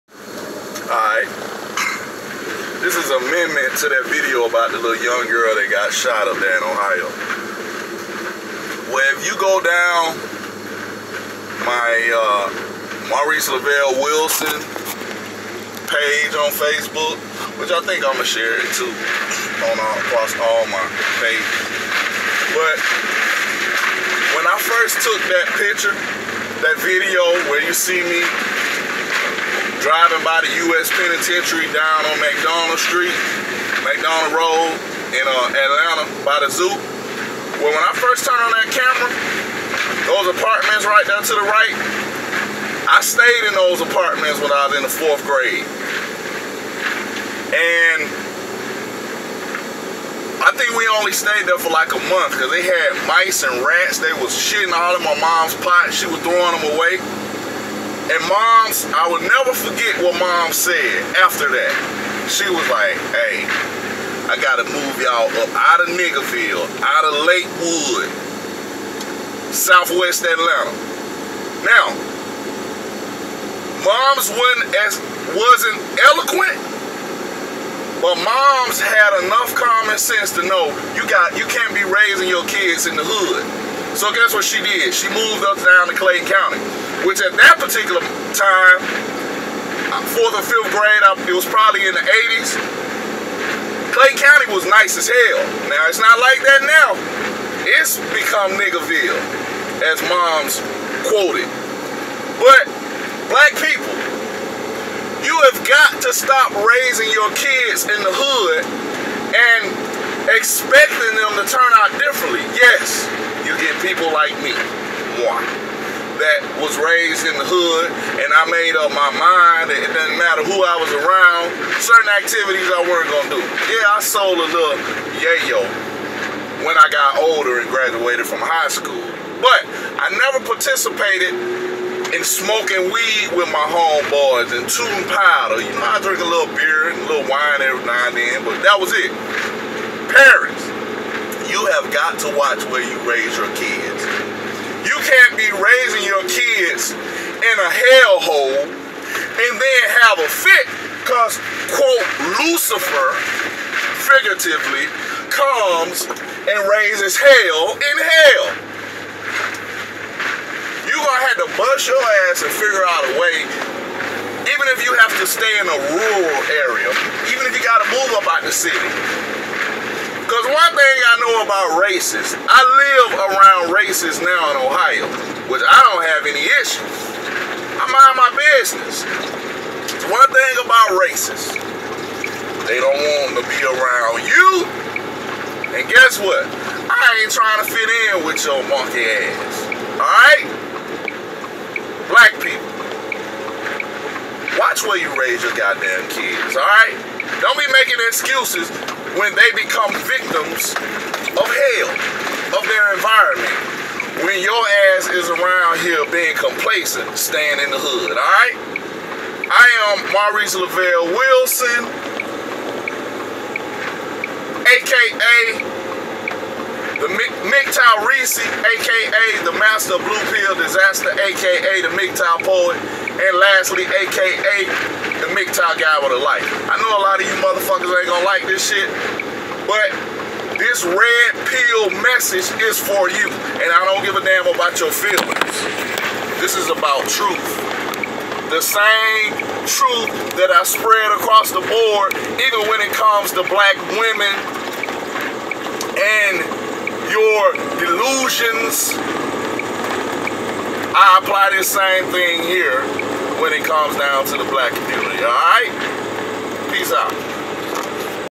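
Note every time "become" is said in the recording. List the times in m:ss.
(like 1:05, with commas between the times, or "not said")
1:38, 3:19.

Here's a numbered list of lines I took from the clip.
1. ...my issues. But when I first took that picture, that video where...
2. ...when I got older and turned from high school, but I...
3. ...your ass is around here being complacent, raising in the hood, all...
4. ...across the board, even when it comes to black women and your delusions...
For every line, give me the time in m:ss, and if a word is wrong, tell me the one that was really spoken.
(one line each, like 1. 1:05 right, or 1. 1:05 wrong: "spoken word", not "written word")
1. 0:20 wrong: "pages", not "issues"
2. 2:06 wrong: "graduated", not "turned"
3. 3:24 wrong: "staying", not "raising"
4. 4:01 right.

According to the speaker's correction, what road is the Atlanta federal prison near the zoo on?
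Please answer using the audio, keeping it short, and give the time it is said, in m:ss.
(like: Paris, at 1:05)
McDonald Road, at 0:33.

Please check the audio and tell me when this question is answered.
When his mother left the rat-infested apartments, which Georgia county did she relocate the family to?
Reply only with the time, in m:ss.
1:25.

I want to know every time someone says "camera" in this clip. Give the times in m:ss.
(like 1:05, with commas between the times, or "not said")
0:38.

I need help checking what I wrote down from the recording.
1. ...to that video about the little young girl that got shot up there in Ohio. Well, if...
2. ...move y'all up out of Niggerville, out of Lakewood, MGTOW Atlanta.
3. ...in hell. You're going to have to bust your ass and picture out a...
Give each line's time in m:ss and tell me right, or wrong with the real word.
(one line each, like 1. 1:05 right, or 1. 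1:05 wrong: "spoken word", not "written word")
1. 0:03 right
2. 1:04 wrong: "Southwest", not "MGTOW"
3. 2:37 wrong: "figure", not "picture".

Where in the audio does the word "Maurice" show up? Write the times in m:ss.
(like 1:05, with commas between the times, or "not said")
0:13, 3:30.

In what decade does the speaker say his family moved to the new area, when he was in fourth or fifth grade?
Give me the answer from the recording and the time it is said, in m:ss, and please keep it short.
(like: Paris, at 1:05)
the 80s, at 1:32.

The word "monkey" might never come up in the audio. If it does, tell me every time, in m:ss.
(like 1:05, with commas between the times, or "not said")
3:08.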